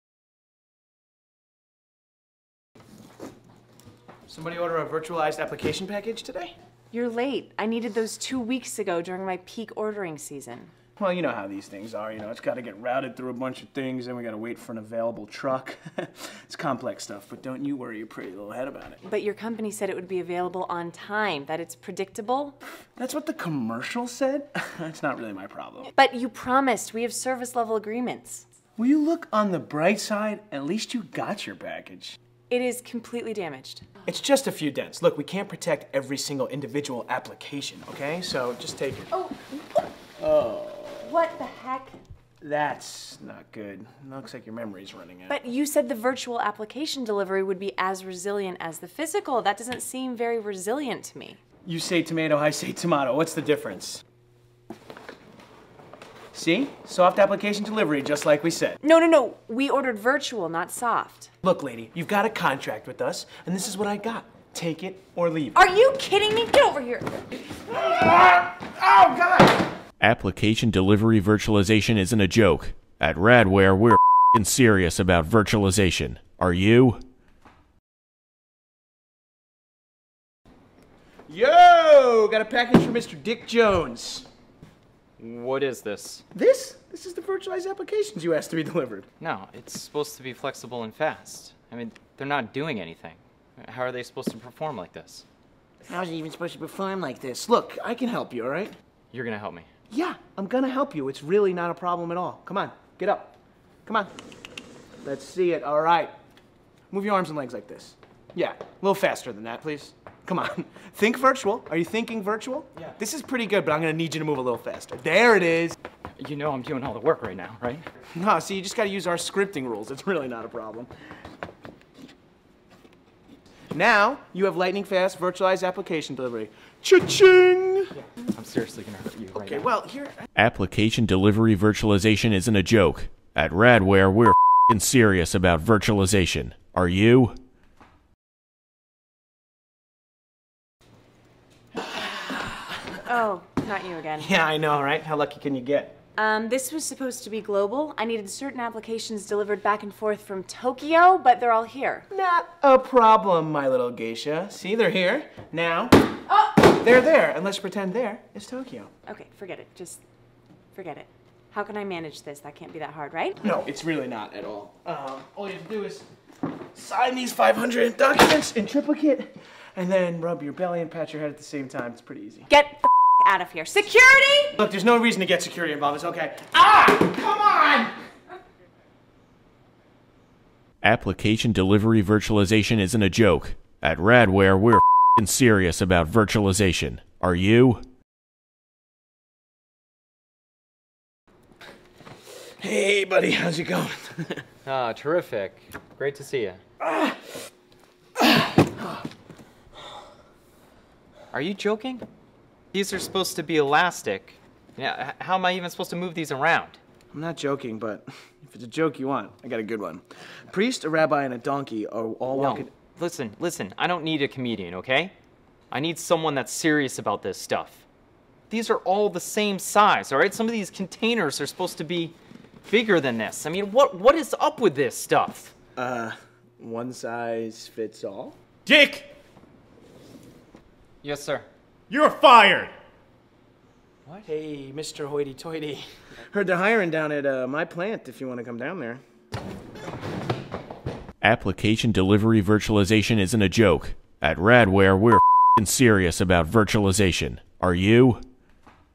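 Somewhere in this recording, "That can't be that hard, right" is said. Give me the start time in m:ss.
2:42.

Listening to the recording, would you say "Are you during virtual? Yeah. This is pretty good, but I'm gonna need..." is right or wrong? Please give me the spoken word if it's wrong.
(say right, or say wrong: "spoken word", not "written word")
wrong: "thinking", not "during".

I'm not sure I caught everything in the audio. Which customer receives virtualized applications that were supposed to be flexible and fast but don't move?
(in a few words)
Dick Jones.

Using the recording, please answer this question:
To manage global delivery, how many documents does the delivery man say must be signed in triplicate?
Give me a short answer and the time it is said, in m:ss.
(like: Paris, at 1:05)
500, at 2:47.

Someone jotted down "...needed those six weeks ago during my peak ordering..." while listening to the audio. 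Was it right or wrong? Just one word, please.
wrong.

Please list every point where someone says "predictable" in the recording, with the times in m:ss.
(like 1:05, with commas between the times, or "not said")
0:21.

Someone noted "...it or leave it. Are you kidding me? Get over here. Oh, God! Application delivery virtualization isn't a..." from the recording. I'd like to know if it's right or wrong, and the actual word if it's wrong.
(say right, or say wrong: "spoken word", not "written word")
right.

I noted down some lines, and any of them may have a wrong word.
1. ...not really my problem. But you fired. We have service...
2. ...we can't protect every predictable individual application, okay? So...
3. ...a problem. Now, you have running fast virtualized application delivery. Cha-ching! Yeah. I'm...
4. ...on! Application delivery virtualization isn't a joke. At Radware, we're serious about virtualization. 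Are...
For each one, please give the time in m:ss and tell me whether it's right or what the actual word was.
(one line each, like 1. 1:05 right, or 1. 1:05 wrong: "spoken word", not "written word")
1. 0:25 wrong: "promised", not "fired"
2. 0:35 wrong: "single", not "predictable"
3. 2:00 wrong: "lightning", not "running"
4. 2:58 right.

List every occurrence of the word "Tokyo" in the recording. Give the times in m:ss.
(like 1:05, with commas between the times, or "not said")
2:30, 2:38.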